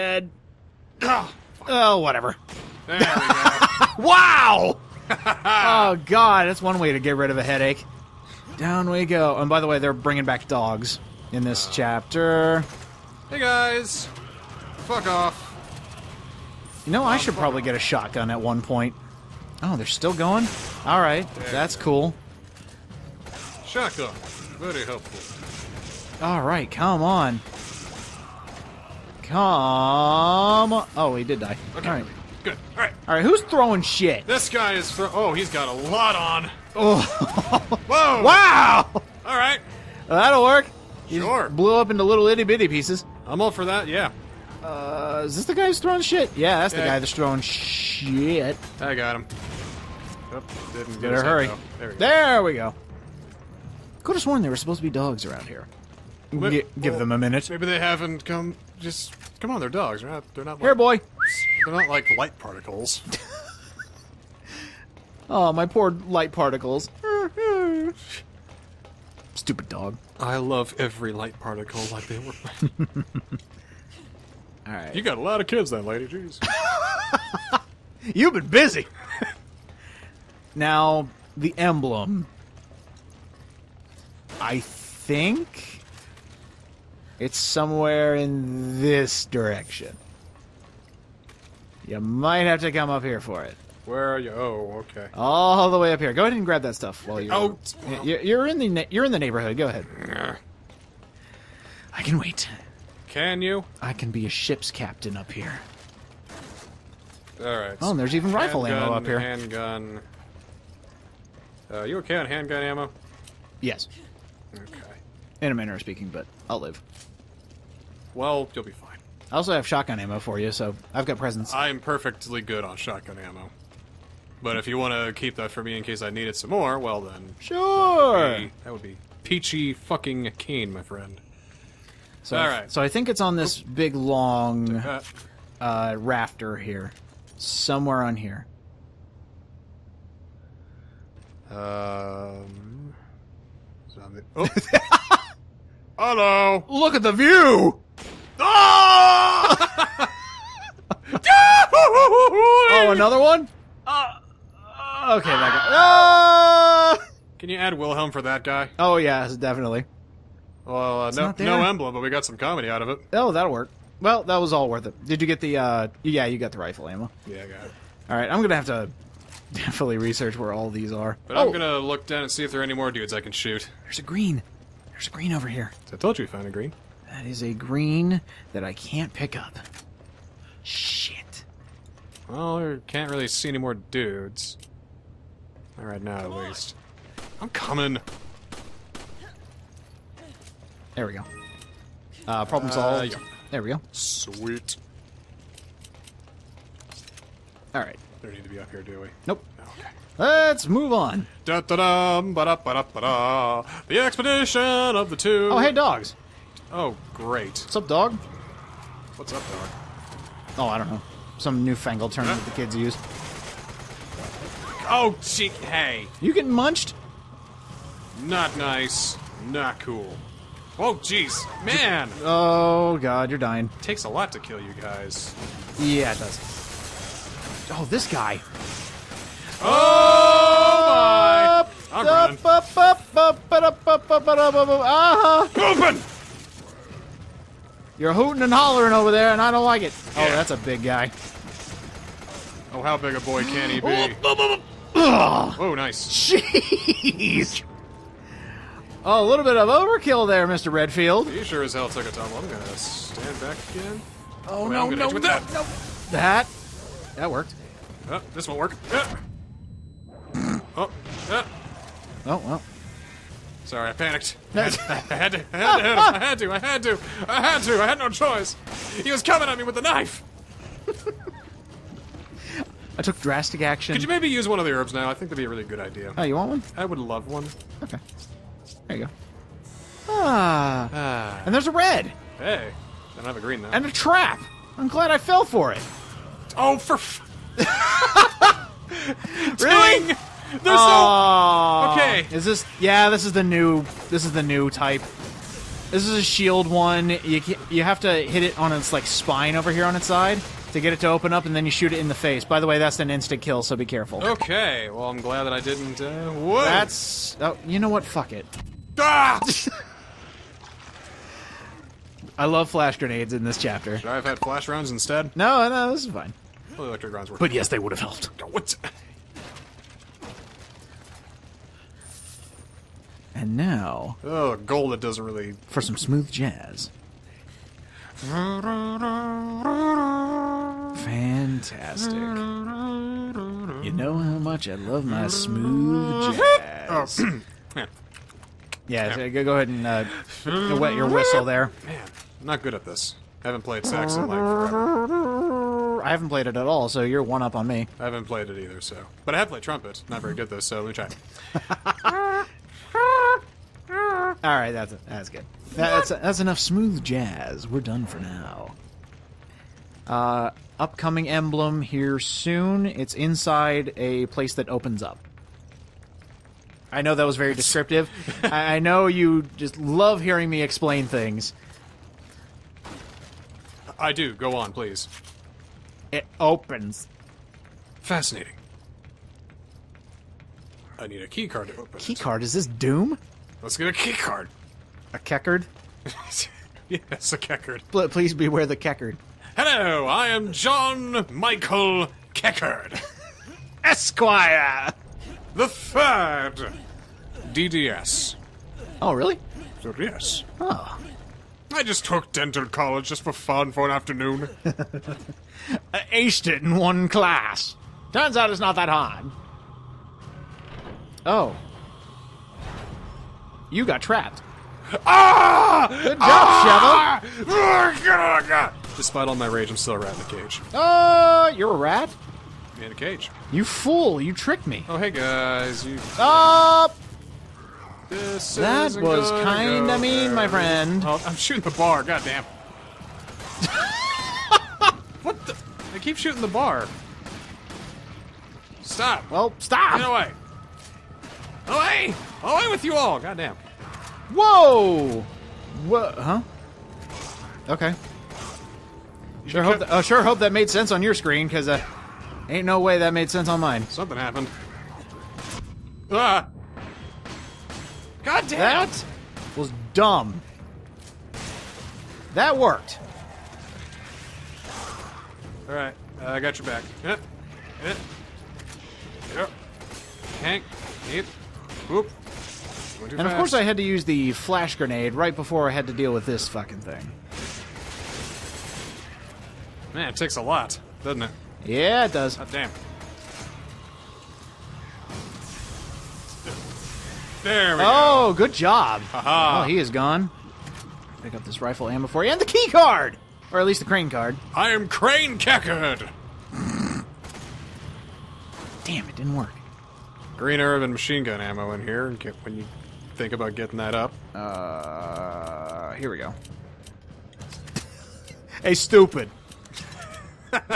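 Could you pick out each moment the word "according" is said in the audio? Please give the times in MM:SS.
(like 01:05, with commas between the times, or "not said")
not said.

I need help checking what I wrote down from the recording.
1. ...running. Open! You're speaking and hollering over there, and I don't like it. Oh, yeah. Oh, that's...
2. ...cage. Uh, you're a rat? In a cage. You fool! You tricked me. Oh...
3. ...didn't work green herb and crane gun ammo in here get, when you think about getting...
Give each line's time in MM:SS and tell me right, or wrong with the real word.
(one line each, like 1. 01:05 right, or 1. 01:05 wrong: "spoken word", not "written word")
1. 03:52 wrong: "hooting", not "speaking"
2. 07:00 right
3. 08:19 wrong: "machine", not "crane".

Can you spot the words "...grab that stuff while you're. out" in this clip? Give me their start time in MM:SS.
01:36.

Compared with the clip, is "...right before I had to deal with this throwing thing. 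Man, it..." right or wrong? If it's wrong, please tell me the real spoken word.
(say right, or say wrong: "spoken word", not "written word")
wrong: "fucking", not "throwing".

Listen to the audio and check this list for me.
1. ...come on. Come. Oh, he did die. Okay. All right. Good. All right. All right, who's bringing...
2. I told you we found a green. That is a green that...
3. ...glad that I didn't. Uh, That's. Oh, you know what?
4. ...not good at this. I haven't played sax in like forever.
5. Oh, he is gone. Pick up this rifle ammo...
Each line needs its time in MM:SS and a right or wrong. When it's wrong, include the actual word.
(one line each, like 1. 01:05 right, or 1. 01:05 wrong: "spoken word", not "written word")
1. 00:26 wrong: "throwing", not "bringing"
2. 02:55 right
3. 05:05 right
4. 05:42 right
5. 08:09 right.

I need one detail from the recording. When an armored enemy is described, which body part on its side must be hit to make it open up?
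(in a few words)
spine.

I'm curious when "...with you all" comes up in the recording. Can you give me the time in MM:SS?
07:22.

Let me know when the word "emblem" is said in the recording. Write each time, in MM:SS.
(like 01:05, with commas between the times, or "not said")
01:21, 02:41, 06:01.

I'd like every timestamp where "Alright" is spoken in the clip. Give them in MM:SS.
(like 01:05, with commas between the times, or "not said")
02:48, 07:45.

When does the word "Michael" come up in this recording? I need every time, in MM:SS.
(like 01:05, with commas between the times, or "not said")
06:31.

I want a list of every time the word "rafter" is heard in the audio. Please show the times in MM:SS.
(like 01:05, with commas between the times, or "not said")
02:15.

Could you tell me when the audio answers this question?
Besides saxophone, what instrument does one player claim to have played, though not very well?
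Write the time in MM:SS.
05:49.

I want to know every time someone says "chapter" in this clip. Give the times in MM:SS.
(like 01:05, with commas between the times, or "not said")
00:11, 05:13.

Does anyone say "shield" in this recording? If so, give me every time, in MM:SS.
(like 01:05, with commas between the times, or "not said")
04:56.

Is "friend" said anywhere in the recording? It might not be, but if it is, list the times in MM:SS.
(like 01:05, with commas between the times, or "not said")
02:10, 07:10.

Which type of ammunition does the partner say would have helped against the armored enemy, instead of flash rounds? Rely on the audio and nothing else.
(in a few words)
electric rounds.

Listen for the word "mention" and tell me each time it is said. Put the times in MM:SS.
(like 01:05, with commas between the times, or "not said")
not said.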